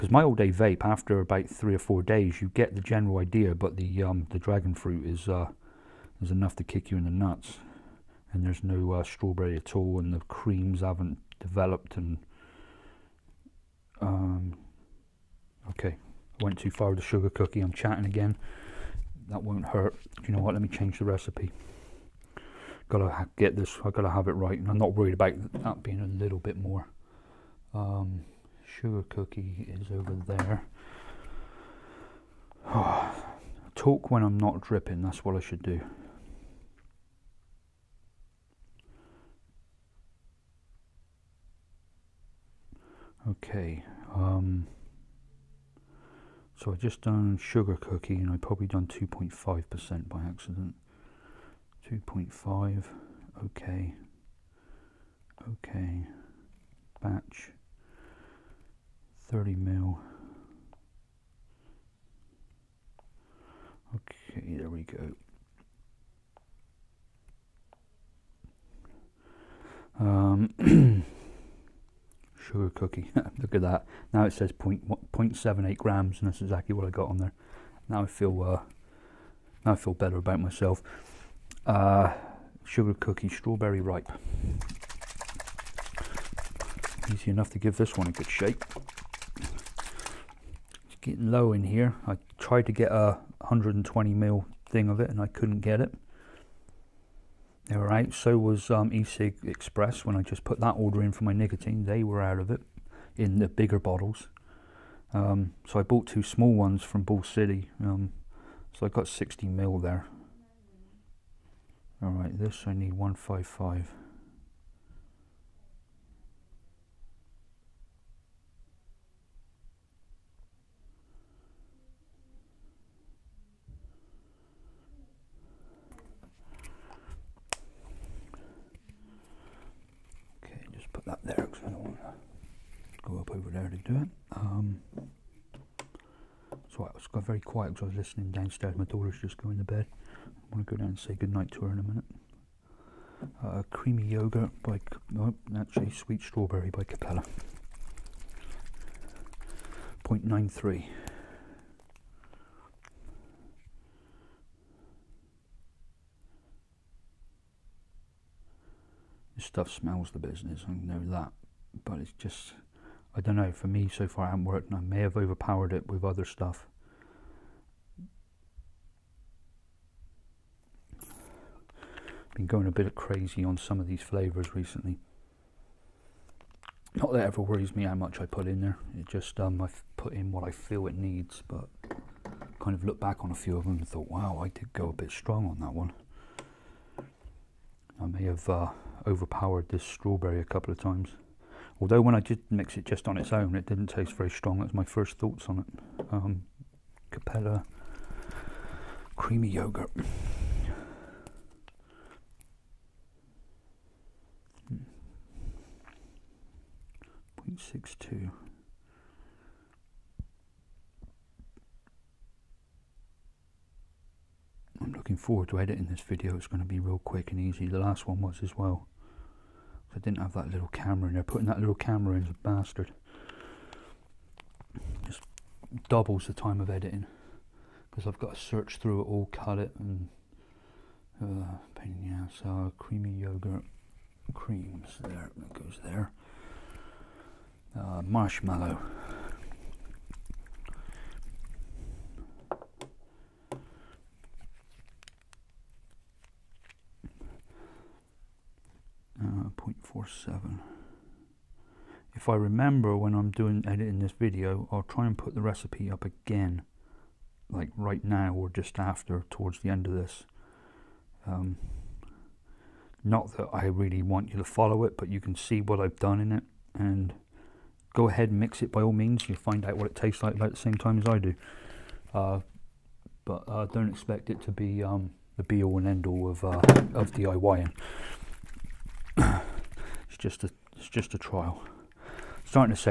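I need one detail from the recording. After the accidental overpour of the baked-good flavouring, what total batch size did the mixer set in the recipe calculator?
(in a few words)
30 ml.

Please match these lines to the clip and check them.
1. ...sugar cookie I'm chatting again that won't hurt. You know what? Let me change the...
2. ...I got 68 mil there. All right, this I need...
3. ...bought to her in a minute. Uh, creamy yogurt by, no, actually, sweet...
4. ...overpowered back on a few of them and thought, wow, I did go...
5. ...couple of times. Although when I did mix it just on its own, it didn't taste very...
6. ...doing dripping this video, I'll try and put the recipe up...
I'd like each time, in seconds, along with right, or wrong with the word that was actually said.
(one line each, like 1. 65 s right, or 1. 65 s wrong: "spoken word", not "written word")
1. 17 s right
2. 108 s wrong: "60", not "68"
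3. 141 s wrong: "goodnight", not "bought"
4. 182 s wrong: "looked", not "overpowered"
5. 190 s right
6. 253 s wrong: "editing", not "dripping".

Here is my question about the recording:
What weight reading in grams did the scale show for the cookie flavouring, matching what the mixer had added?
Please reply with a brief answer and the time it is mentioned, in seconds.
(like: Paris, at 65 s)
0.78 grams, at 74 s.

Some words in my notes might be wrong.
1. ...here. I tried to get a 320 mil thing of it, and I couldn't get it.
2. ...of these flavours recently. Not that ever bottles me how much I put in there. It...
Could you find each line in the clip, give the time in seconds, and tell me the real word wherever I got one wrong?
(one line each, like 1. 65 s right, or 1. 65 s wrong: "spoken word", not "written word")
1. 91 s wrong: "120", not "320"
2. 173 s wrong: "worries", not "bottles".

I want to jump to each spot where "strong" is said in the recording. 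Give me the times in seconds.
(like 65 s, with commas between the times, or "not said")
185 s, 194 s.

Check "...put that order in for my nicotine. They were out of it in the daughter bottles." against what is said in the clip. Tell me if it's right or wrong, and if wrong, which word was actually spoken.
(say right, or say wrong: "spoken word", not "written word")
wrong: "bigger", not "daughter".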